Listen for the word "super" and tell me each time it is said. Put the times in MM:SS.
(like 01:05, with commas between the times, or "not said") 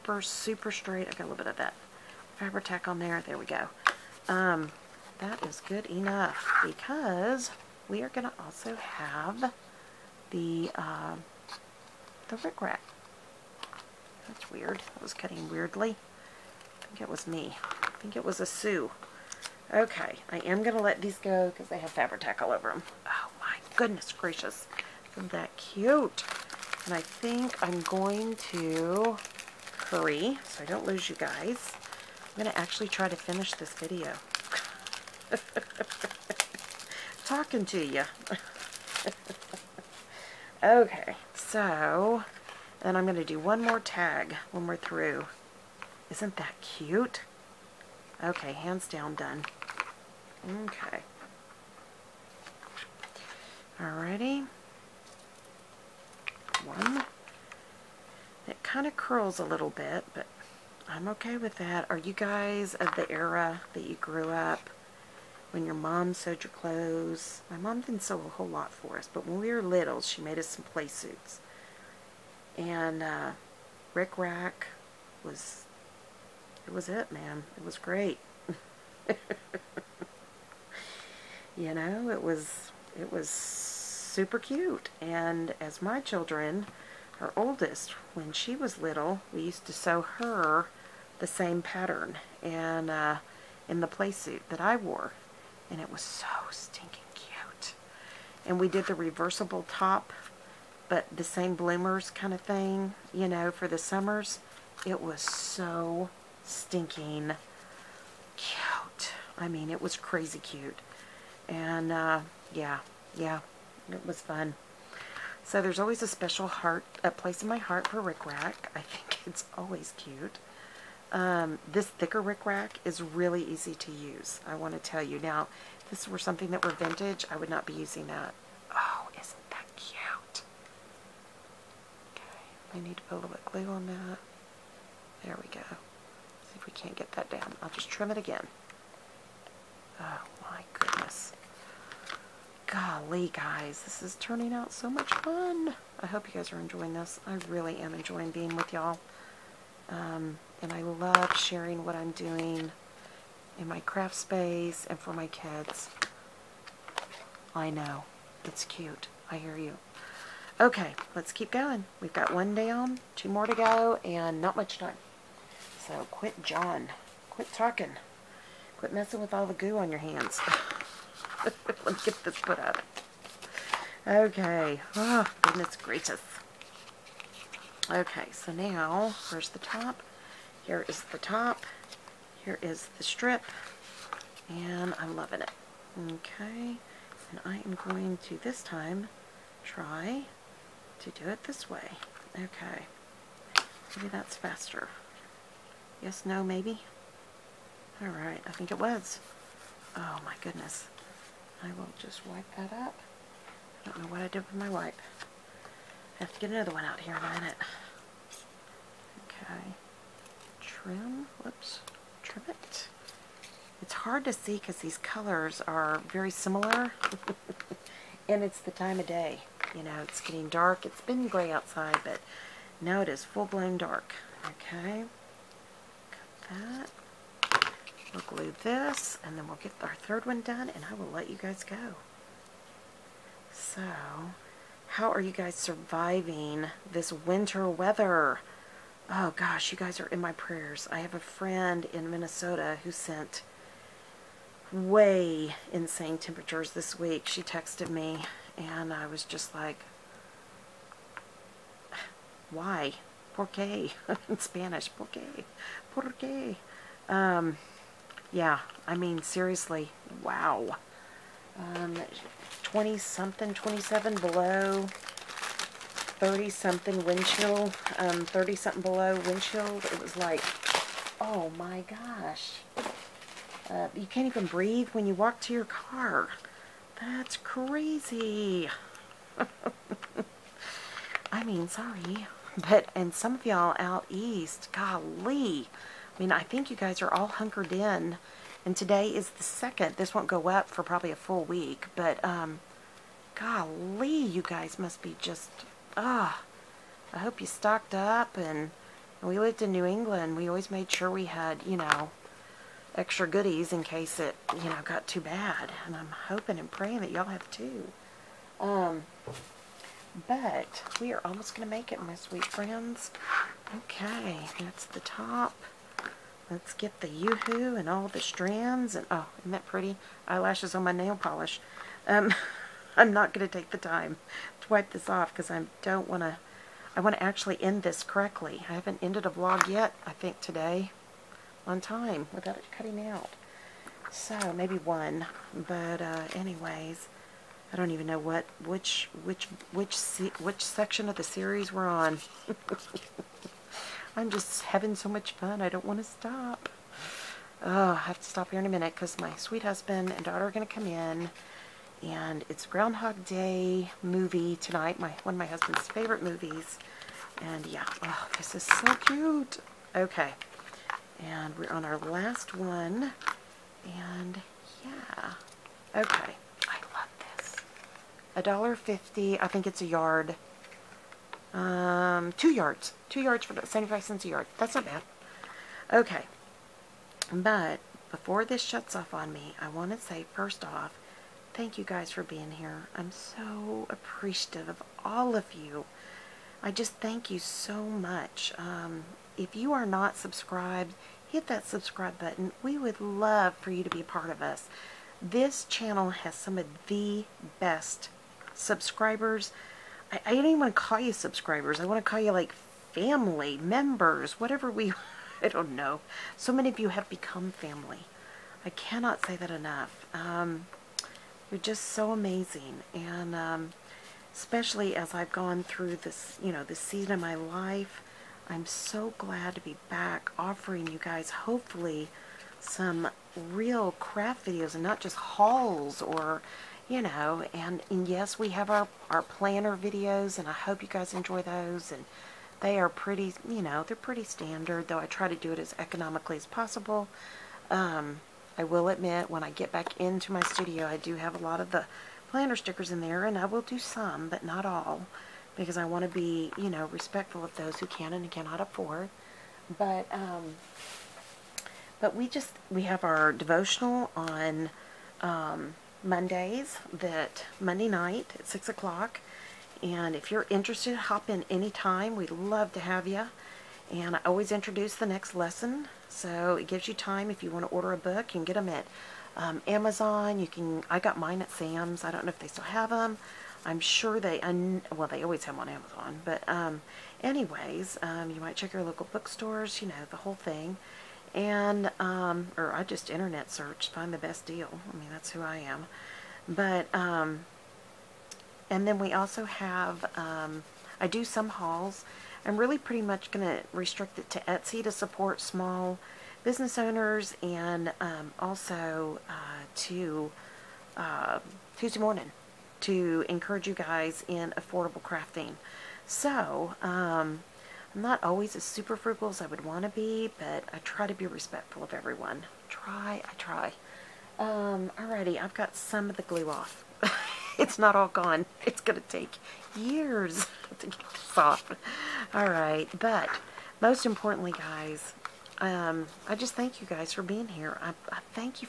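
00:00, 01:23, 08:28.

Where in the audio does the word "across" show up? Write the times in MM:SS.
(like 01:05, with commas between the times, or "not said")
not said.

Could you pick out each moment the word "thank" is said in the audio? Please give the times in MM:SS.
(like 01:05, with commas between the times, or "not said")
06:21, 06:26, 08:46.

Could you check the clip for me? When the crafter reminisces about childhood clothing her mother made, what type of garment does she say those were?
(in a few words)
Play suits.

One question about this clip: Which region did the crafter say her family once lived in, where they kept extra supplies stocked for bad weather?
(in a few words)
New England.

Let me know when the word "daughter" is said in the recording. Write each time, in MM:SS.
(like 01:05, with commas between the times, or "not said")
05:50.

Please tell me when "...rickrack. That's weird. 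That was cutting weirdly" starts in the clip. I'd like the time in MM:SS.
00:12.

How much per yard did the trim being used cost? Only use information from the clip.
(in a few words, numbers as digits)
75 cents.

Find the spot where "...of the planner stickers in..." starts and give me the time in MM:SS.
07:21.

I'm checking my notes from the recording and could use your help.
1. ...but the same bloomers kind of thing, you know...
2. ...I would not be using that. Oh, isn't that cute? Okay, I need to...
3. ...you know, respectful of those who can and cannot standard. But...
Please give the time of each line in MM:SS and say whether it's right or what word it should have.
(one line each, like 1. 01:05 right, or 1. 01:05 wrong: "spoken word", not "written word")
1. 01:40 right
2. 02:07 right
3. 07:26 wrong: "afford", not "standard".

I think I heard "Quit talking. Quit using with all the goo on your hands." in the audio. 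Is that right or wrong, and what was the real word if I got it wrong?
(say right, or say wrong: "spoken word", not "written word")
wrong: "messing", not "using".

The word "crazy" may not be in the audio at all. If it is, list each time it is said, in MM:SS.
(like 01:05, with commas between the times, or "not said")
01:49, 04:37.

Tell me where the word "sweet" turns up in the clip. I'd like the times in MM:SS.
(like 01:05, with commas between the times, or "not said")
05:12, 05:49.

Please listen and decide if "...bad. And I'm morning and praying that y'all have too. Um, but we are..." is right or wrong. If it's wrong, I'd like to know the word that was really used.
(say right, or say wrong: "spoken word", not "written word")
wrong: "hoping", not "morning".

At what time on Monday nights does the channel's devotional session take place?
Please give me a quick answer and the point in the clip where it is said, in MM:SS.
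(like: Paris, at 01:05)
6 o'clock, at 07:38.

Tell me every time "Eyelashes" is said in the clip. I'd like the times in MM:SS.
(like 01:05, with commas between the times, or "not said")
05:20.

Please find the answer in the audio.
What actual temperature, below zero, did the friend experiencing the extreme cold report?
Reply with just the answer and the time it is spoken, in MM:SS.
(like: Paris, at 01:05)
27 below, at 04:23.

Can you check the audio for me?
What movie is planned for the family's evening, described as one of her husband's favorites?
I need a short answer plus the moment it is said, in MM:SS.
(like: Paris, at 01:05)
Groundhog Day, at 05:52.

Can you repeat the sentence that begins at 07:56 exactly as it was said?
But um, anyways, um, you might check your local bookstores.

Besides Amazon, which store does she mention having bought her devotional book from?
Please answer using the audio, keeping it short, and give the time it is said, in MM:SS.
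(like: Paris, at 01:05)
Sam's, at 07:51.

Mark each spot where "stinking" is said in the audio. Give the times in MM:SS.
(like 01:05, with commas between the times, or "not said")
01:36, 01:46.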